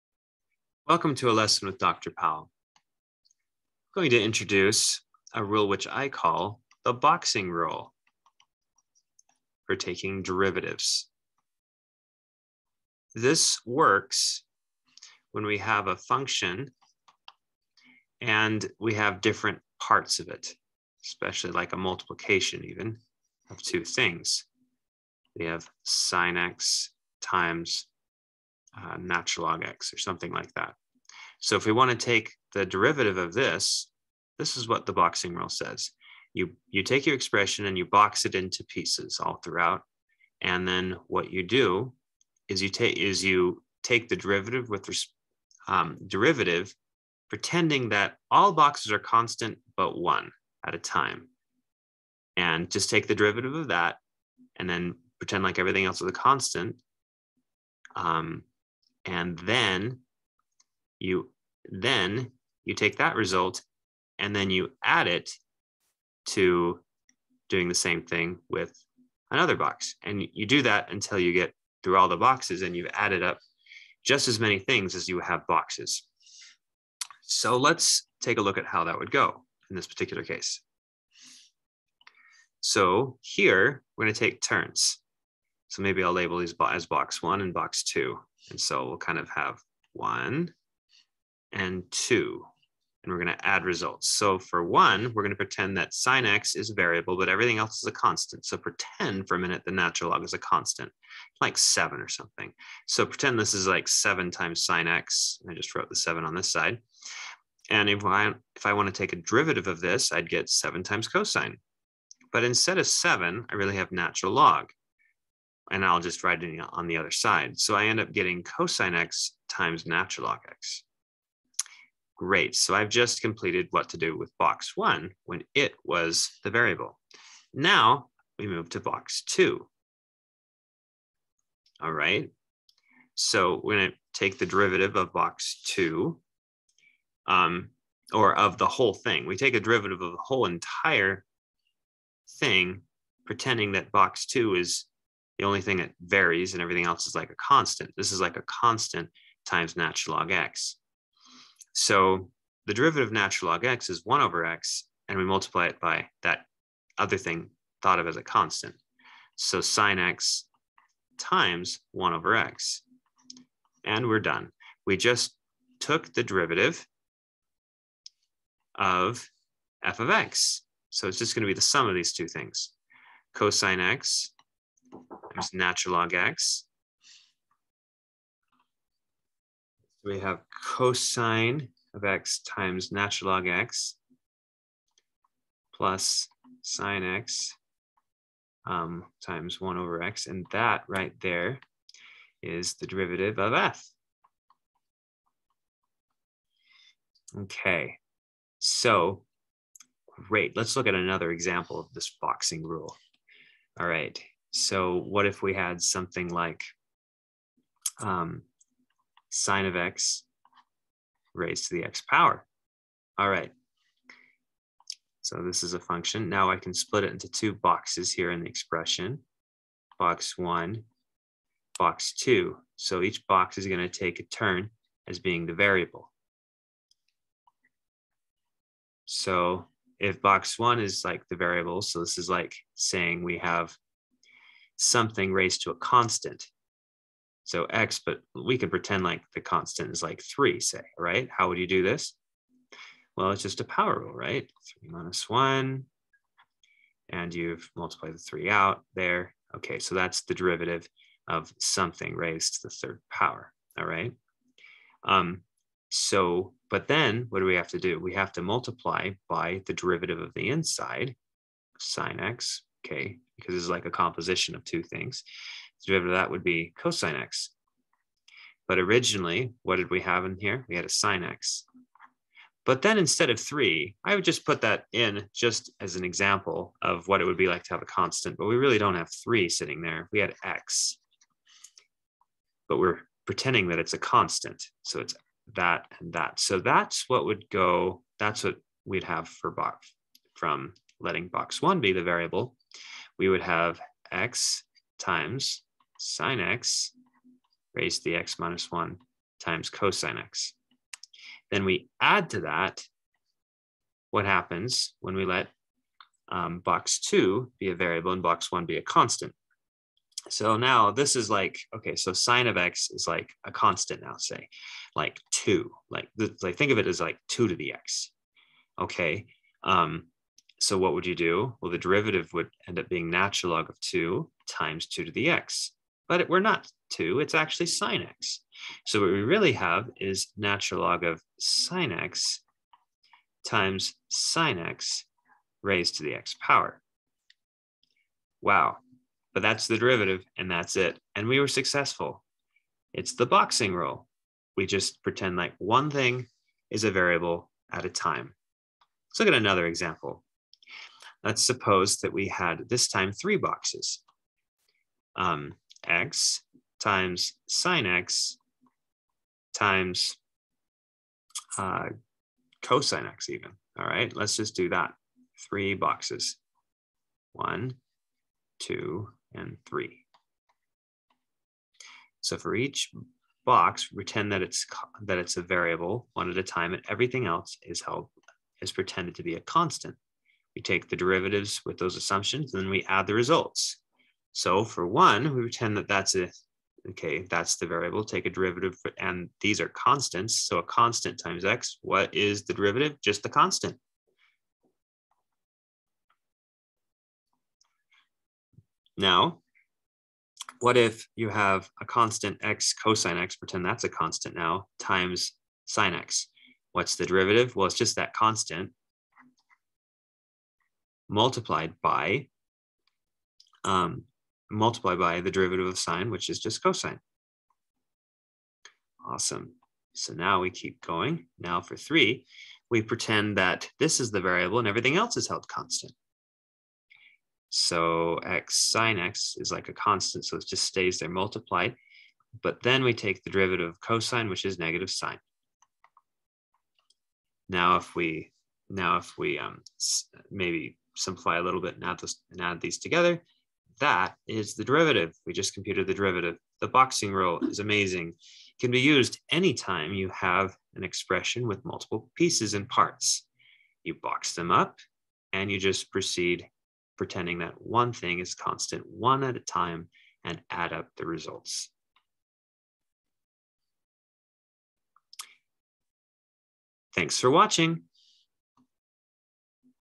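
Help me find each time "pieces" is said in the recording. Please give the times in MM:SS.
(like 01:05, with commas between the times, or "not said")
00:38, 07:32.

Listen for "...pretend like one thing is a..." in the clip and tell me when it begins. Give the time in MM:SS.
05:45.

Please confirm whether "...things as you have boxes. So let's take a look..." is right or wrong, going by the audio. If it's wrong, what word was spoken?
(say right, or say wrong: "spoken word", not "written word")
right.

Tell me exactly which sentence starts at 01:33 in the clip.
And we're going to add results.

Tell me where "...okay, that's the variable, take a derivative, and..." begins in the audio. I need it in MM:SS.
06:26.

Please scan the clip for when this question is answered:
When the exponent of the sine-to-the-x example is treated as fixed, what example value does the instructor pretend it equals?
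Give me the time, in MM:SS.
04:00.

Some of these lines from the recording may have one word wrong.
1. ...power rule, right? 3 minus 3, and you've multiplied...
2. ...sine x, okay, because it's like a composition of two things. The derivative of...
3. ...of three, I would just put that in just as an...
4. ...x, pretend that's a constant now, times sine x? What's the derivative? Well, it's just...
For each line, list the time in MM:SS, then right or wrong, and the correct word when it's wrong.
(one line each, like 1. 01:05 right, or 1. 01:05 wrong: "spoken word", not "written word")
1. 04:03 wrong: "1", not "3"
2. 04:21 right
3. 04:33 right
4. 06:43 right.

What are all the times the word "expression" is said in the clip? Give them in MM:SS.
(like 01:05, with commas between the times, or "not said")
00:37, 03:38, 07:30.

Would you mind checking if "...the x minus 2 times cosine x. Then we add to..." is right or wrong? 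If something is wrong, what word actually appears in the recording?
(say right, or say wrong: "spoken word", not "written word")
wrong: "1", not "2".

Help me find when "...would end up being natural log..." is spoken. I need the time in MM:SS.
05:22.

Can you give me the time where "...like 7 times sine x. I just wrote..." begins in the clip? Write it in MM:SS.
01:43.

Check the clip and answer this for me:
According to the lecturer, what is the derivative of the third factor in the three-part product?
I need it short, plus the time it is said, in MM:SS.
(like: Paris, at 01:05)
negative sine, at 07:14.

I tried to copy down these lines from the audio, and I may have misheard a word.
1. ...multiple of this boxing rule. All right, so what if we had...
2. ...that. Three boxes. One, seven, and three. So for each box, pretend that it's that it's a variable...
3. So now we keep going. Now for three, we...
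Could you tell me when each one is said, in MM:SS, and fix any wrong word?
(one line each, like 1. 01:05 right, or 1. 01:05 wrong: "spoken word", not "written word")
1. 03:21 wrong: "example", not "multiple"
2. 06:04 wrong: "two", not "seven"
3. 06:59 right.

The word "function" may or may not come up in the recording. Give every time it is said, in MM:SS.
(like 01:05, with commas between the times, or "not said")
00:15, 03:35.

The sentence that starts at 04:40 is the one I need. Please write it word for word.
We had x, but we're pretending that it's a constant.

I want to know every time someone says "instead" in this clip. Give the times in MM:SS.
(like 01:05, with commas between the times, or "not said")
01:52, 04:32.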